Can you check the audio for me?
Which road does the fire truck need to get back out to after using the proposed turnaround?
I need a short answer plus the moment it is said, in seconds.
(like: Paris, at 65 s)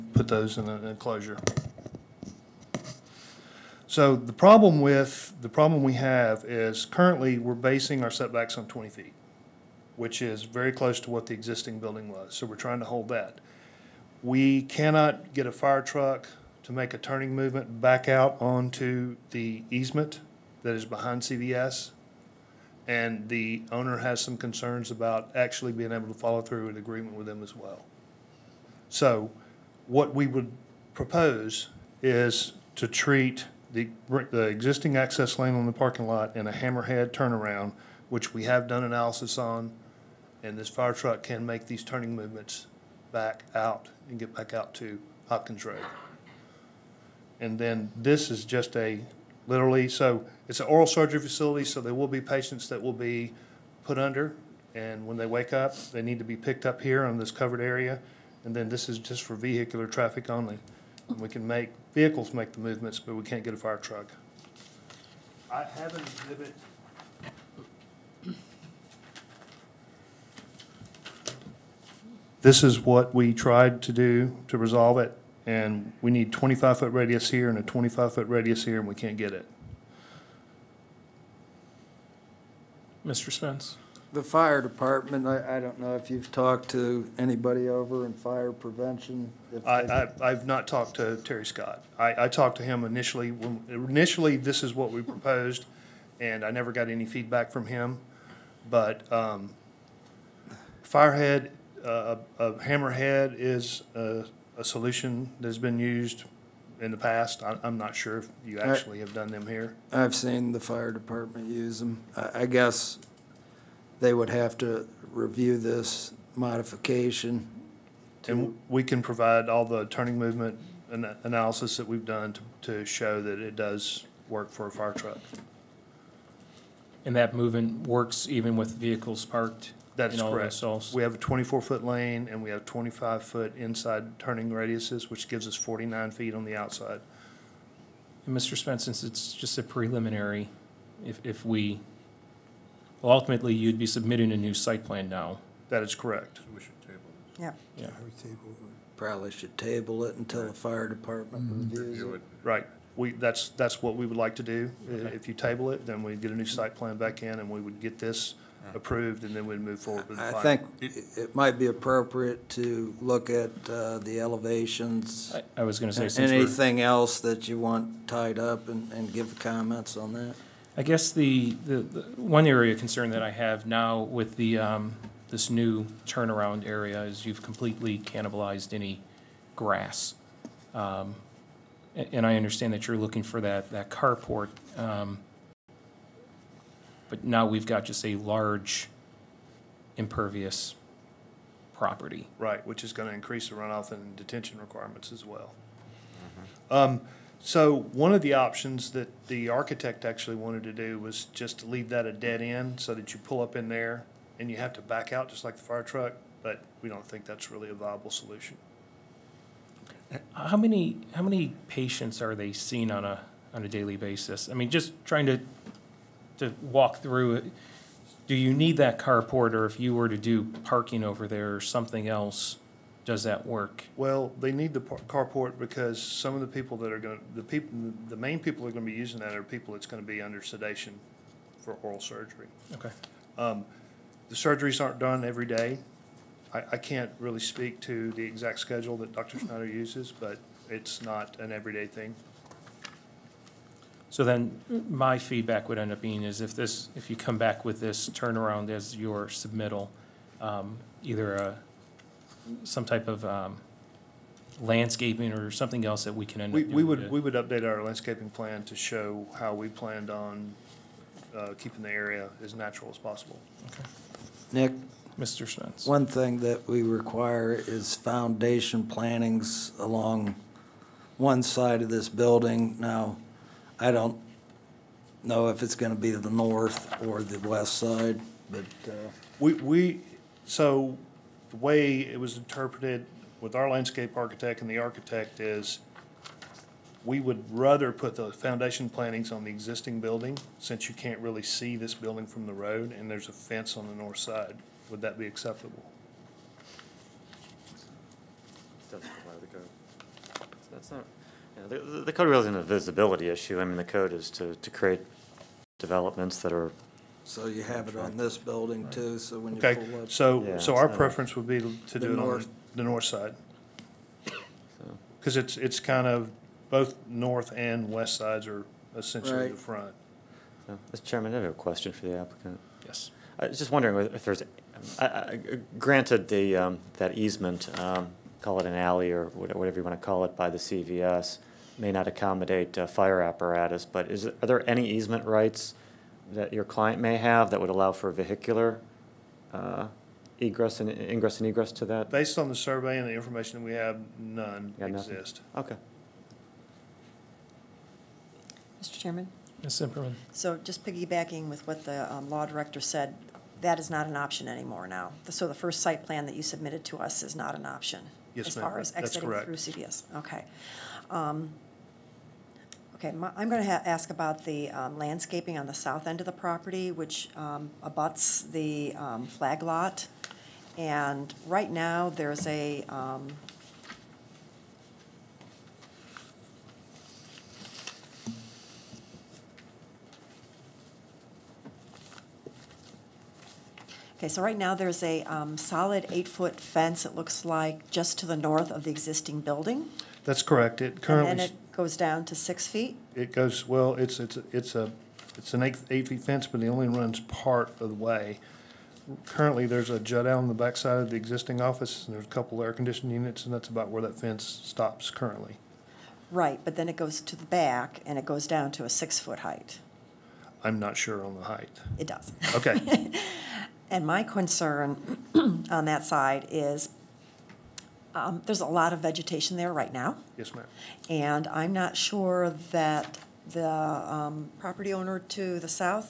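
Hopkins Road, at 45 s.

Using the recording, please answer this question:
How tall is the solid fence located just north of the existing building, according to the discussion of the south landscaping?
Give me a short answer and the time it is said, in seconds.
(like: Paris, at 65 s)
8 feet, at 386 s.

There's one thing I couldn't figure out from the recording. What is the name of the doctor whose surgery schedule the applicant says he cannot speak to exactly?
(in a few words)
Dr. Schneider.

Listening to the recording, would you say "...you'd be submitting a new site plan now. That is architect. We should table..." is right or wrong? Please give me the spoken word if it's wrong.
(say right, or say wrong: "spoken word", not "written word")
wrong: "correct", not "architect".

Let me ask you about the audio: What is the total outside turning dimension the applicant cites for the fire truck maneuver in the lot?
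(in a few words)
49 feet.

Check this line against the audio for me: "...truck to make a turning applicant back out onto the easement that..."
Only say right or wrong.
wrong.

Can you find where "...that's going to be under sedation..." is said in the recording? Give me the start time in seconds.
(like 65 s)
229 s.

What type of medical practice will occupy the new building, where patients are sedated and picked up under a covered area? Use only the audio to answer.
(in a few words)
oral surgery facility.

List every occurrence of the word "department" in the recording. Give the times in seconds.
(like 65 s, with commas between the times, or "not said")
84 s, 110 s, 150 s.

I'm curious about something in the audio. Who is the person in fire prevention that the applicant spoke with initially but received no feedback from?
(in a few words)
Terry Scott.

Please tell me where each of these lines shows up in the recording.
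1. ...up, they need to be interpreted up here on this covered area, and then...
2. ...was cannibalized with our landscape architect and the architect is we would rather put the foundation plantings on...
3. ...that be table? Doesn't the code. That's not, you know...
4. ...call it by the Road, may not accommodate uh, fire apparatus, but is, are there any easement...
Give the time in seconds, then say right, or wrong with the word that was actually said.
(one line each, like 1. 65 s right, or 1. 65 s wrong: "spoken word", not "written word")
1. 55 s wrong: "picked", not "interpreted"
2. 282 s wrong: "interpreted", not "cannibalized"
3. 295 s wrong: "acceptable", not "table"
4. 330 s wrong: "CVS", not "Road".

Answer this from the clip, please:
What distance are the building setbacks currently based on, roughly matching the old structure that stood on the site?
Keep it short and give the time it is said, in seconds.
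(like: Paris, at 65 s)
20 feet, at 8 s.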